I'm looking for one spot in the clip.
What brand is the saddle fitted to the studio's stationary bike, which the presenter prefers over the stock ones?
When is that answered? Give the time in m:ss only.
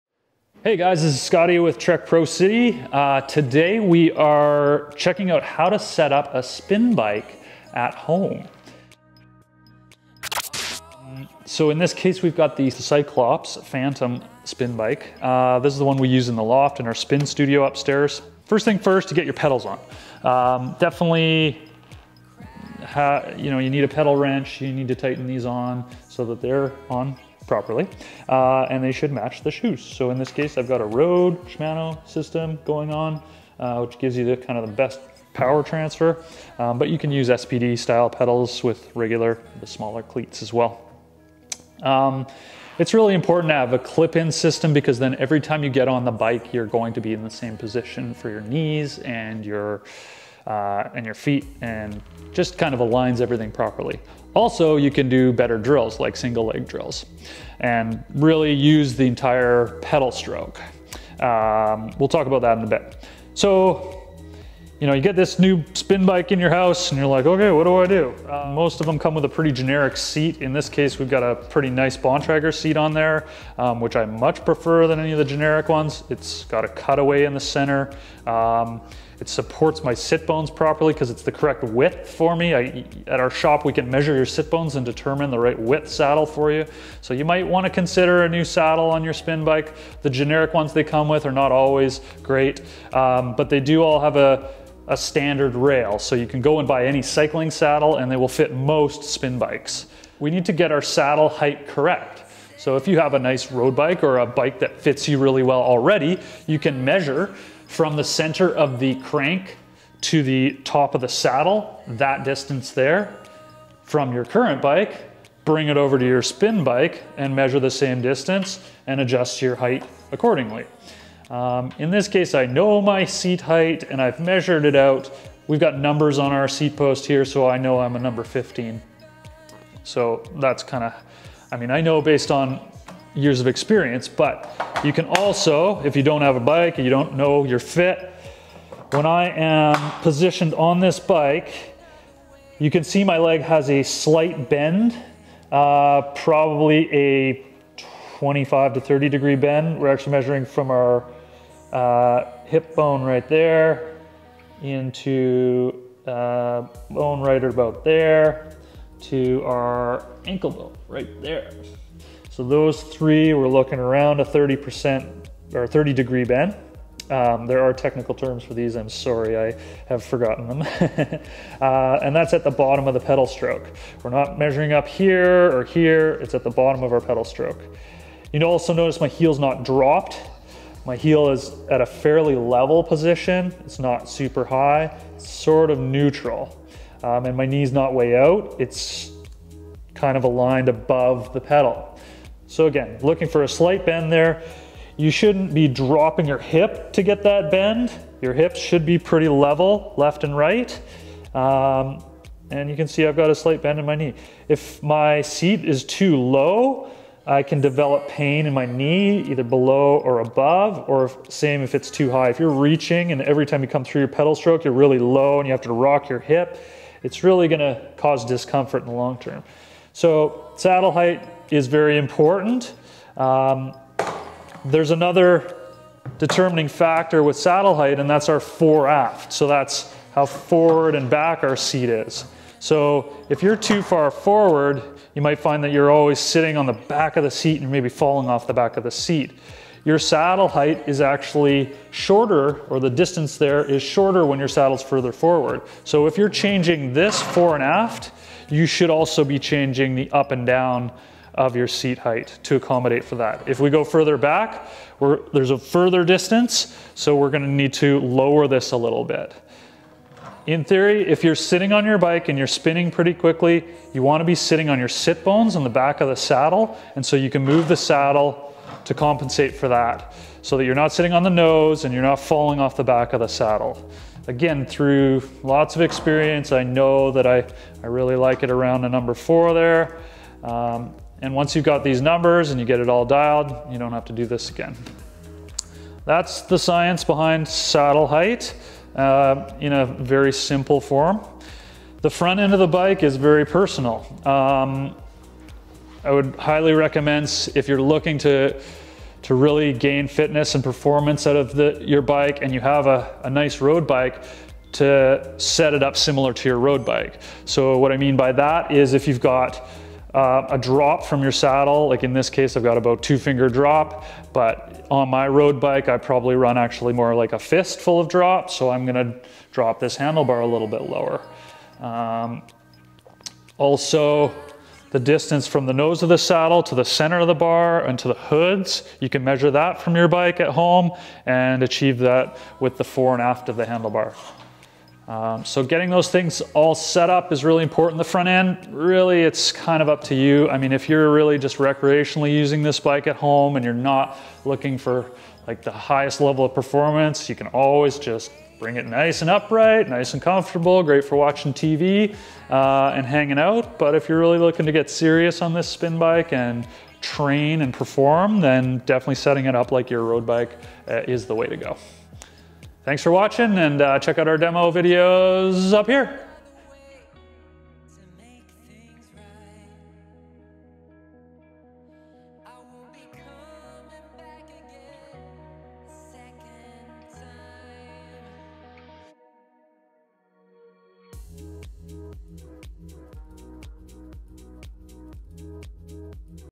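1:11.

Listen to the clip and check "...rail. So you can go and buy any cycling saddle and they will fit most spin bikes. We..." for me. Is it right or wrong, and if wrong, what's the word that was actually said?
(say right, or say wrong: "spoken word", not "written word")
right.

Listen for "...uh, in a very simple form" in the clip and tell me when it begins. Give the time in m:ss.
4:48.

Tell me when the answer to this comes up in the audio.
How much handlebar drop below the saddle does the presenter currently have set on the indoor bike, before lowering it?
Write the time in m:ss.
5:13.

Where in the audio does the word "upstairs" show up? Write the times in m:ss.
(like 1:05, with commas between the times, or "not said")
0:17.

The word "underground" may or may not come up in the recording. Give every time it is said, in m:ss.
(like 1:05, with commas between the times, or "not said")
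not said.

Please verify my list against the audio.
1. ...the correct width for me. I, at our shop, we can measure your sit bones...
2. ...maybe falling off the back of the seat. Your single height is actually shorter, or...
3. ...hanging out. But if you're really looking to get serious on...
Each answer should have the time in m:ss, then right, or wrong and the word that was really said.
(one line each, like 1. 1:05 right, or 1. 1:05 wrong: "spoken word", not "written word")
1. 1:21 right
2. 3:57 wrong: "saddle", not "single"
3. 5:53 right.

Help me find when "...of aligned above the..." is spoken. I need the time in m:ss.
3:10.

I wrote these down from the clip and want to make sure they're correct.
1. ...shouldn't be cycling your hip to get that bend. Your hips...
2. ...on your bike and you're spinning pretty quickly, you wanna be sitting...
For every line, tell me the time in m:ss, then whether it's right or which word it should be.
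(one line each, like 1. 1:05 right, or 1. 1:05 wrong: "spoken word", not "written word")
1. 3:15 wrong: "dropping", not "cycling"
2. 4:21 right.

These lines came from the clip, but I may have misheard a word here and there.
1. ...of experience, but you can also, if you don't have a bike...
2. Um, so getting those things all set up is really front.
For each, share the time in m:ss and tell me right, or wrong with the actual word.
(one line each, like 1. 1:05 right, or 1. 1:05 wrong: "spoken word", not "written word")
1. 2:13 right
2. 5:35 wrong: "important", not "front".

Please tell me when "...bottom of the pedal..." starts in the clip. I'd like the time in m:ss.
2:52.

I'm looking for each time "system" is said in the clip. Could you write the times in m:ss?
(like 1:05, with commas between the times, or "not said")
0:32, 0:44.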